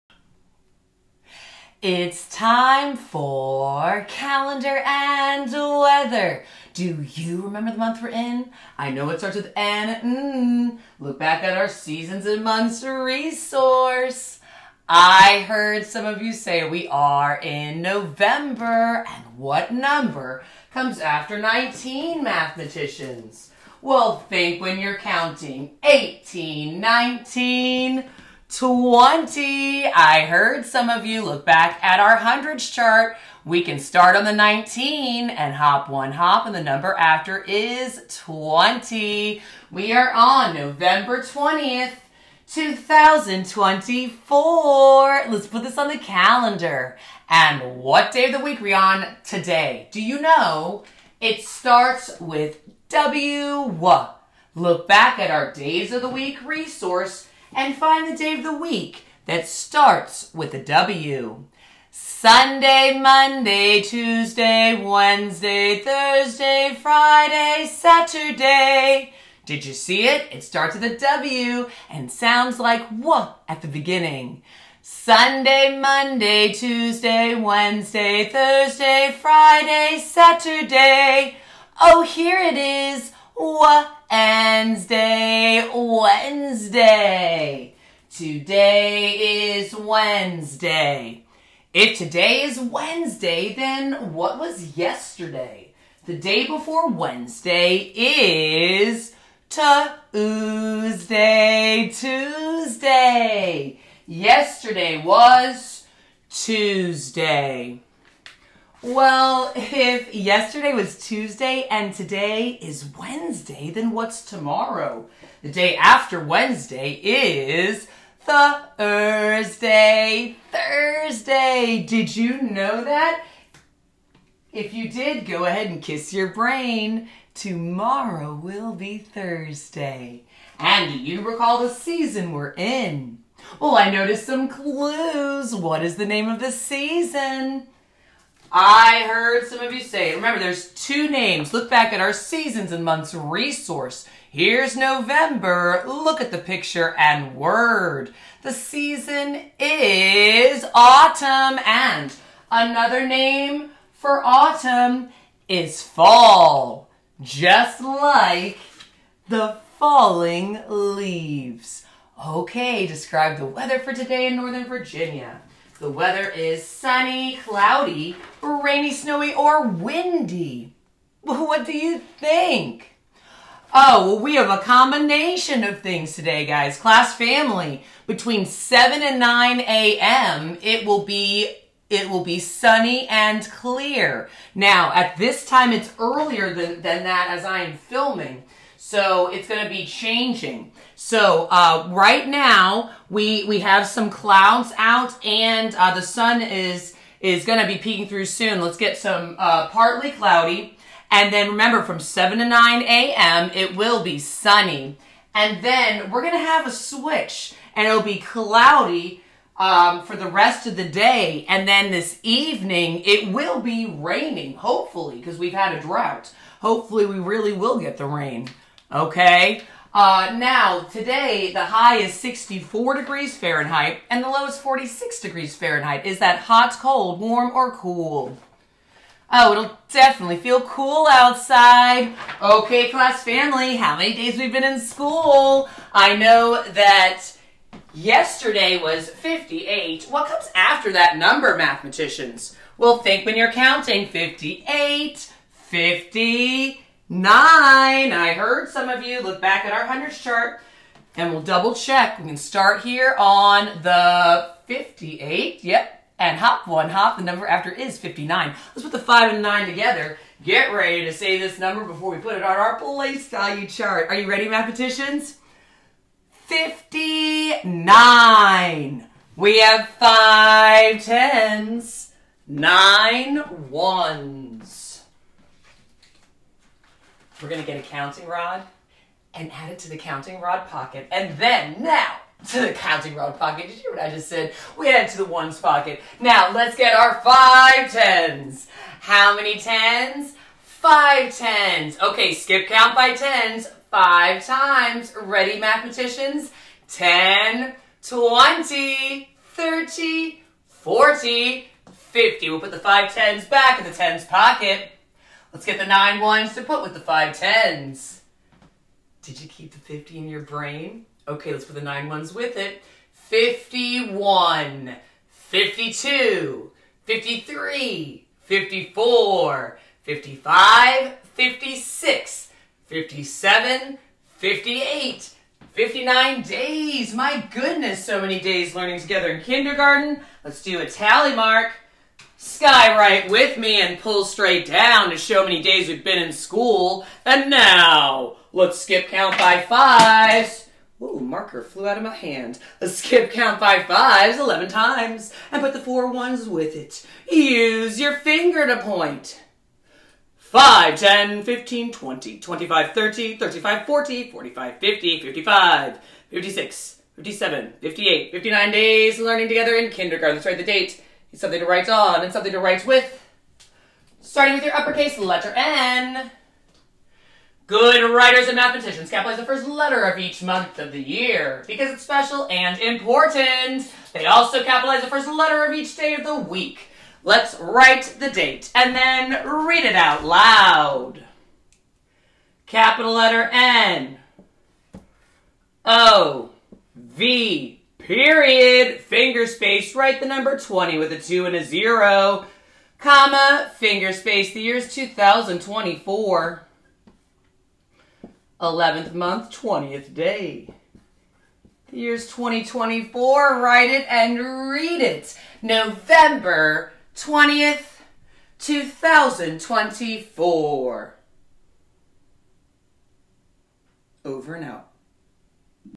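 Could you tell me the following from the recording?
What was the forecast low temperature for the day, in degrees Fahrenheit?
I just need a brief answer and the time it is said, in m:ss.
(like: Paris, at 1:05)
46 degrees, at 3:44.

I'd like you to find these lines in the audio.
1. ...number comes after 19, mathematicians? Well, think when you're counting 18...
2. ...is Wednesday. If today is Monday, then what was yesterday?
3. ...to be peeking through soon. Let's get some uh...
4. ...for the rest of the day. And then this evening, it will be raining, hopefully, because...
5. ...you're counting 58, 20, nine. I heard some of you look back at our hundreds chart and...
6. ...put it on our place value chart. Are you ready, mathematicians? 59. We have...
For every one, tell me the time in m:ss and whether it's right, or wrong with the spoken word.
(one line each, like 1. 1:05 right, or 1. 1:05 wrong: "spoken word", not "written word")
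1. 0:19 right
2. 1:29 wrong: "Wednesday", not "Monday"
3. 3:17 right
4. 3:30 right
5. 4:03 wrong: "50", not "20"
6. 4:22 right.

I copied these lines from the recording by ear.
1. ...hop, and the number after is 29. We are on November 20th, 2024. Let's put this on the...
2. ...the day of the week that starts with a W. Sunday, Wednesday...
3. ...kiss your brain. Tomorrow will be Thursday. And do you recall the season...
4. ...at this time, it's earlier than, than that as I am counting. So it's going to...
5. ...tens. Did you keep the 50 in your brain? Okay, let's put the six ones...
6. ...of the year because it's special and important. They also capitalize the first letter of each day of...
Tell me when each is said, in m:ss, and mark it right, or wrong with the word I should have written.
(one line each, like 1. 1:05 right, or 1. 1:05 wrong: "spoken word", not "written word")
1. 0:36 wrong: "20", not "29"
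2. 0:58 wrong: "Monday", not "Wednesday"
3. 2:05 right
4. 3:04 wrong: "filming", not "counting"
5. 5:07 wrong: "nine", not "six"
6. 6:10 right.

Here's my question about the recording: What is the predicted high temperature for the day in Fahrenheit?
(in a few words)
64 degrees.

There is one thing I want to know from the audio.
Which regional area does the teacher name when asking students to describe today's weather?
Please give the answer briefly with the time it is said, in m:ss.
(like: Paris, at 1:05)
Northern Virginia, at 2:44.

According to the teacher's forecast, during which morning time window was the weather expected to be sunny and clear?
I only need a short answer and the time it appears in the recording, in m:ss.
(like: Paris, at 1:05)
7 to 9 a.m., at 2:58.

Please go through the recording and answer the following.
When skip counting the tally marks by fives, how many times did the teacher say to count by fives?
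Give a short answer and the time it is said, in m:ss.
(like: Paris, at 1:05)
11 times, at 5:44.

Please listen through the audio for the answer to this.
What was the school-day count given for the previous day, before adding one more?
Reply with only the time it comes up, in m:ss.
3:57.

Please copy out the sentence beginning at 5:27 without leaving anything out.
My goodness, so many days learning together in kindergarten.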